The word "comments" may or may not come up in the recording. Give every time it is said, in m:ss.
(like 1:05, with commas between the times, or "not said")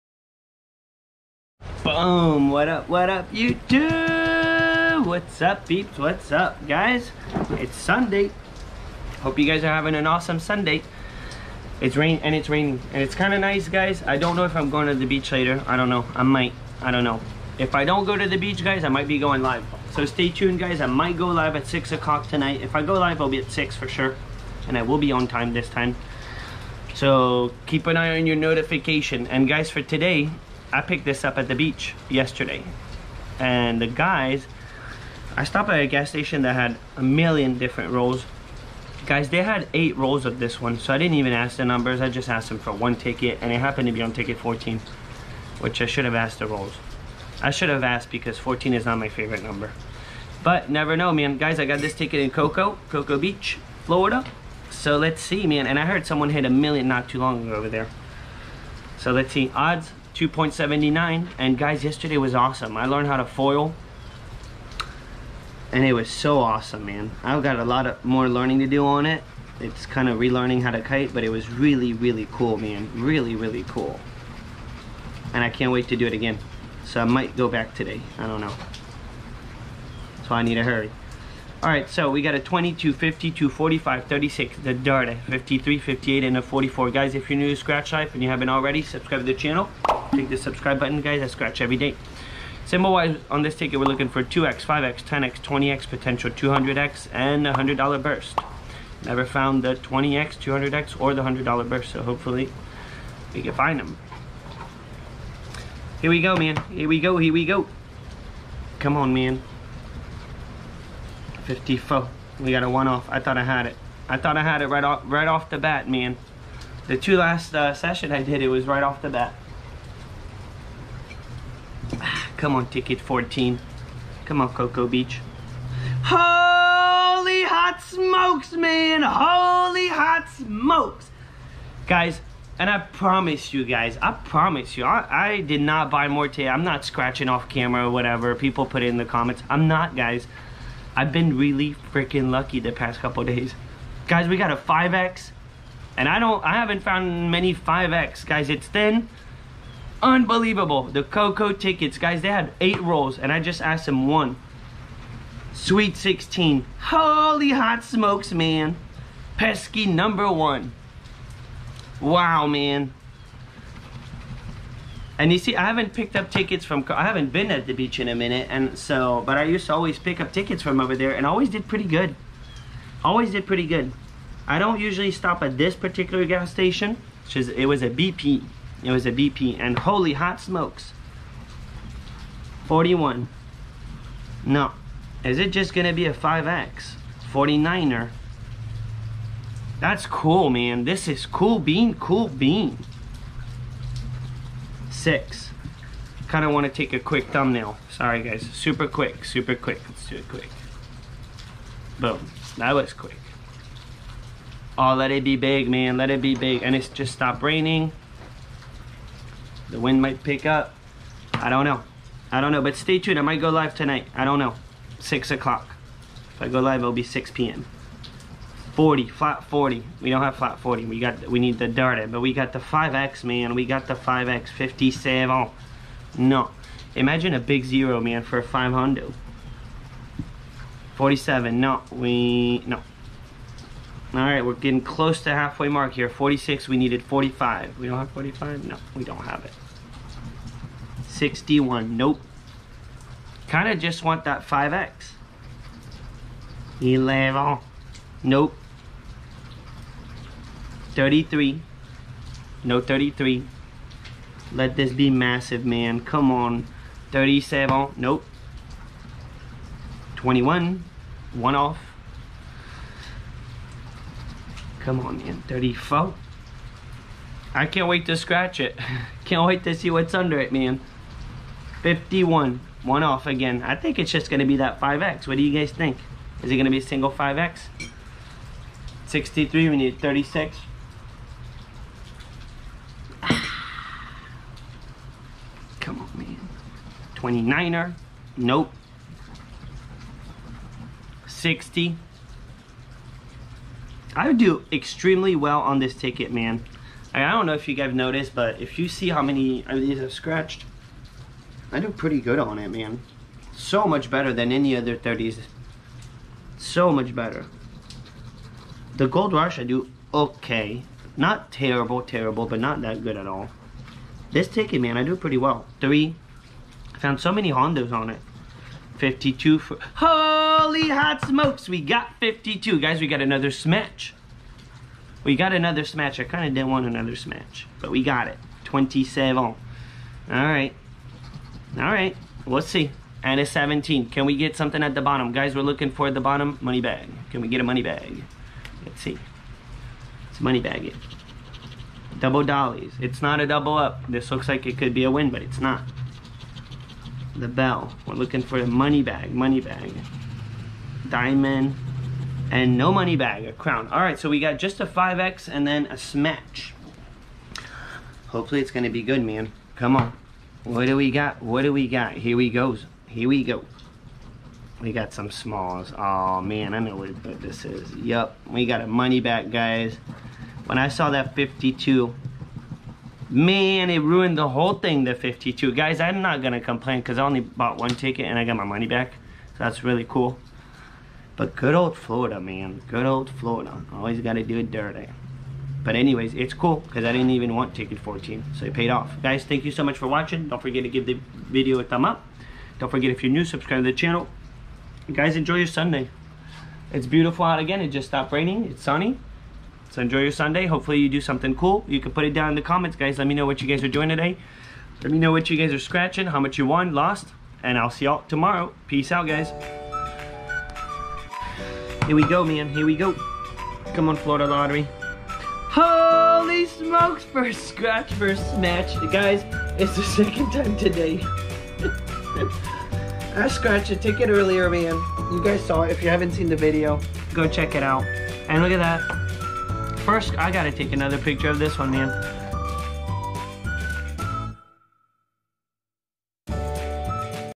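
2:19, 6:42.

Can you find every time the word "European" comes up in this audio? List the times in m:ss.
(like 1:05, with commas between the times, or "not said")
not said.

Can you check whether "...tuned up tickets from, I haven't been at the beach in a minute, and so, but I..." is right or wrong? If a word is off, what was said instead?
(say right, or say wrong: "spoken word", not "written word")
wrong: "picked", not "tuned".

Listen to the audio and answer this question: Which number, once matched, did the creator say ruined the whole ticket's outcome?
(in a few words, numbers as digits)
52.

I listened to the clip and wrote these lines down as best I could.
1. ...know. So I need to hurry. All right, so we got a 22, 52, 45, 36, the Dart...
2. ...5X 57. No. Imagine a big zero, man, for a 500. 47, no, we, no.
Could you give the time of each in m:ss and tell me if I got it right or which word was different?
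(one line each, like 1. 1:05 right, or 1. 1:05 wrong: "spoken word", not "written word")
1. 1:18 right
2. 3:43 right.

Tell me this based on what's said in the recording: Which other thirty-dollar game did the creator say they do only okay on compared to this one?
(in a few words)
Gold Rush.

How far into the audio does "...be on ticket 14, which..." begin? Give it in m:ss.
0:43.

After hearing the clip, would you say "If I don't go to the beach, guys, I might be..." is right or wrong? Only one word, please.
right.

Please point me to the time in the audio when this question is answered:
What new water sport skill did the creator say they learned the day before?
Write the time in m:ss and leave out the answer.
1:03.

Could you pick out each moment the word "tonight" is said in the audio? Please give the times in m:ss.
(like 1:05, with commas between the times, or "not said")
0:22, 3:33.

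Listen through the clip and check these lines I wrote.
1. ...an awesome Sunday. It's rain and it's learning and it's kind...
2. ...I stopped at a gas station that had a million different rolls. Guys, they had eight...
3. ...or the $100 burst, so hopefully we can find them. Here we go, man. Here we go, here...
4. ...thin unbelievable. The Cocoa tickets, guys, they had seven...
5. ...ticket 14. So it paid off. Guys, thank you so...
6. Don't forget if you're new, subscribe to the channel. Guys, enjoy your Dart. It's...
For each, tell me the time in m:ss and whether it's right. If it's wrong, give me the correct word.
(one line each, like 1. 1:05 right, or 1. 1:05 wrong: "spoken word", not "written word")
1. 0:09 wrong: "raining", not "learning"
2. 0:35 right
3. 1:40 right
4. 2:28 wrong: "eight", not "seven"
5. 6:27 right
6. 6:32 wrong: "Sunday", not "Dart".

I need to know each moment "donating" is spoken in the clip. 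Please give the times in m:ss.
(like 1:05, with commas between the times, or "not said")
not said.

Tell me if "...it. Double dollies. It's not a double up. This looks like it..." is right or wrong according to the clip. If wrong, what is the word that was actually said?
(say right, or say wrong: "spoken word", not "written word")
right.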